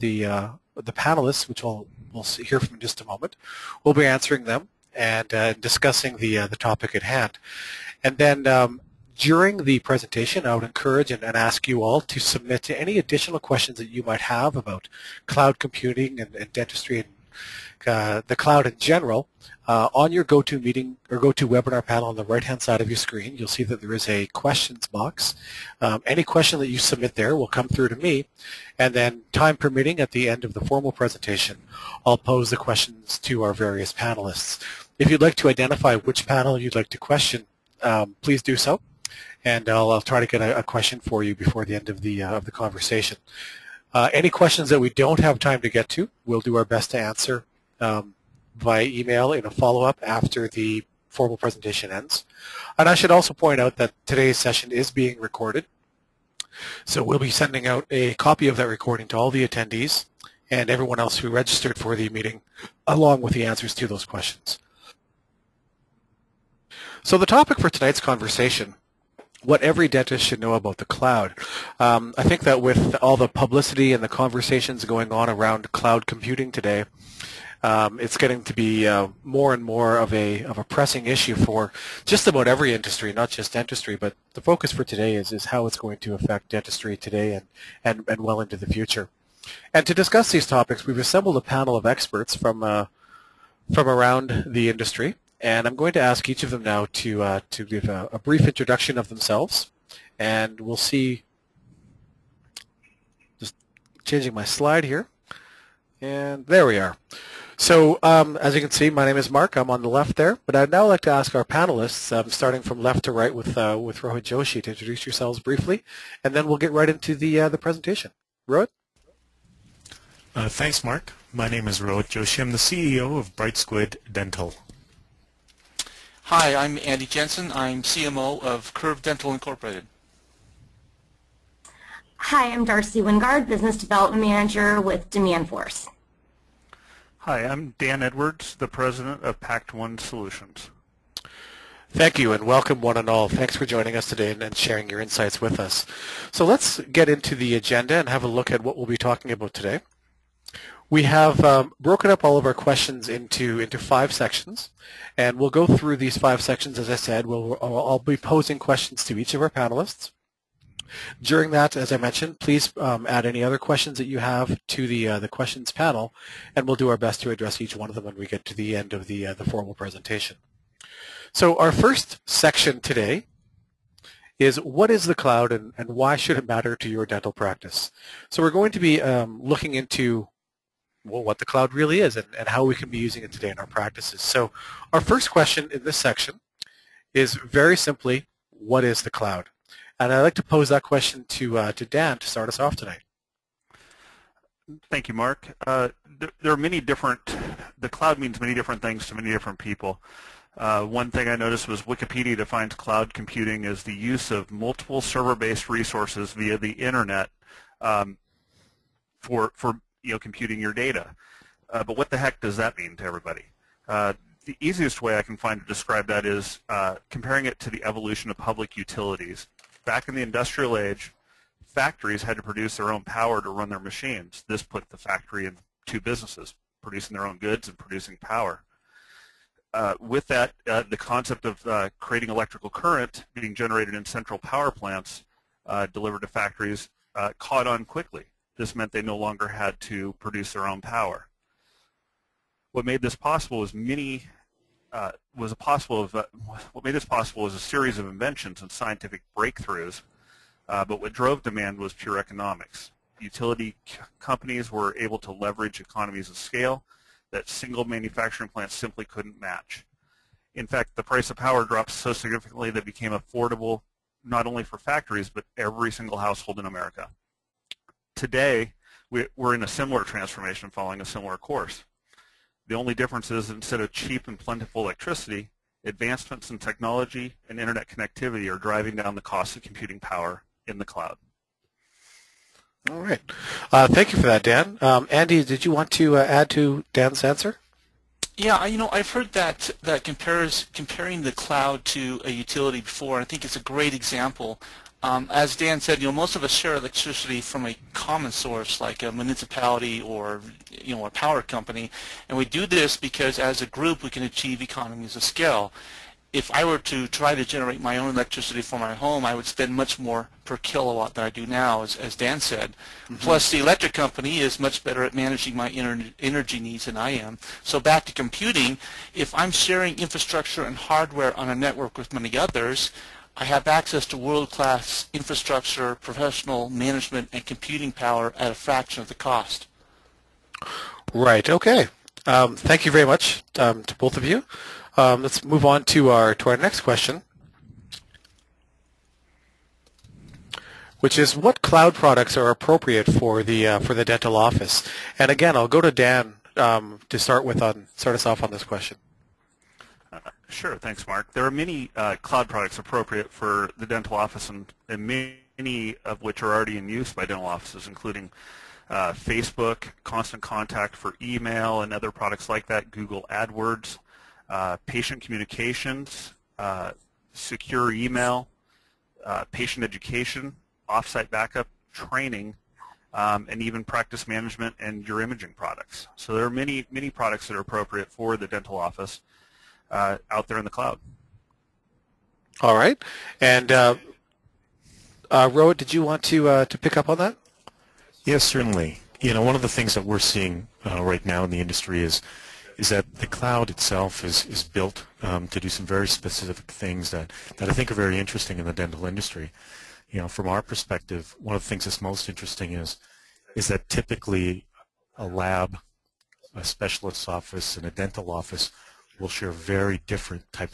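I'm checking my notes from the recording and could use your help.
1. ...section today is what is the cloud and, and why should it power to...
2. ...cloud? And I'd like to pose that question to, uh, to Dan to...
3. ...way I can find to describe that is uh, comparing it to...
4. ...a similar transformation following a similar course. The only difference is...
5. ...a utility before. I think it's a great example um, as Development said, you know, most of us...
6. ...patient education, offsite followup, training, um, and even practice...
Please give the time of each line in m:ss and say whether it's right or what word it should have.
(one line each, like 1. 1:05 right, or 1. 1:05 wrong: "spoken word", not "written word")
1. 2:52 wrong: "matter", not "power"
2. 3:09 right
3. 3:35 right
4. 4:29 right
5. 4:52 wrong: "Dan", not "Development"
6. 6:09 wrong: "backup", not "followup".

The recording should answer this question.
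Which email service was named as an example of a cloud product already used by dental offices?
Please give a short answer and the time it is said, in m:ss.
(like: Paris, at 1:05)
Constant Contact, at 6:00.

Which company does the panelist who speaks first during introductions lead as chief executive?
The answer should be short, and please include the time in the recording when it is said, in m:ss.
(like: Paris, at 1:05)
Brightsquid Dental, at 2:03.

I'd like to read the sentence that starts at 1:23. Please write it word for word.
But the focus for today is is how it's going to affect dentistry today and and, and well into the future.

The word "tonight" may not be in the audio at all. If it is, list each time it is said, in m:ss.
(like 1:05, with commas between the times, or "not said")
1:07, 3:12.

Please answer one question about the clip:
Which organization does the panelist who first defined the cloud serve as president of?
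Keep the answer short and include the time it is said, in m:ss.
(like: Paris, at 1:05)
Pact-One Solutions, at 2:19.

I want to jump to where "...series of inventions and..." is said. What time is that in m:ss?
4:07.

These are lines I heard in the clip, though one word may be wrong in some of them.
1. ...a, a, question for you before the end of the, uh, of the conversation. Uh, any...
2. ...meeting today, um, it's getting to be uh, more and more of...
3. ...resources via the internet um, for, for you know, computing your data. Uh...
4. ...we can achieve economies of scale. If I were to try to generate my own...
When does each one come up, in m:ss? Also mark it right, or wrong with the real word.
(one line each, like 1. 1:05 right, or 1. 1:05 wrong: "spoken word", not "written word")
1. 0:40 right
2. 1:16 wrong: "computing", not "meeting"
3. 3:25 right
4. 5:04 right.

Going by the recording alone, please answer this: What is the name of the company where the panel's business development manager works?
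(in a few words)
DemandForce.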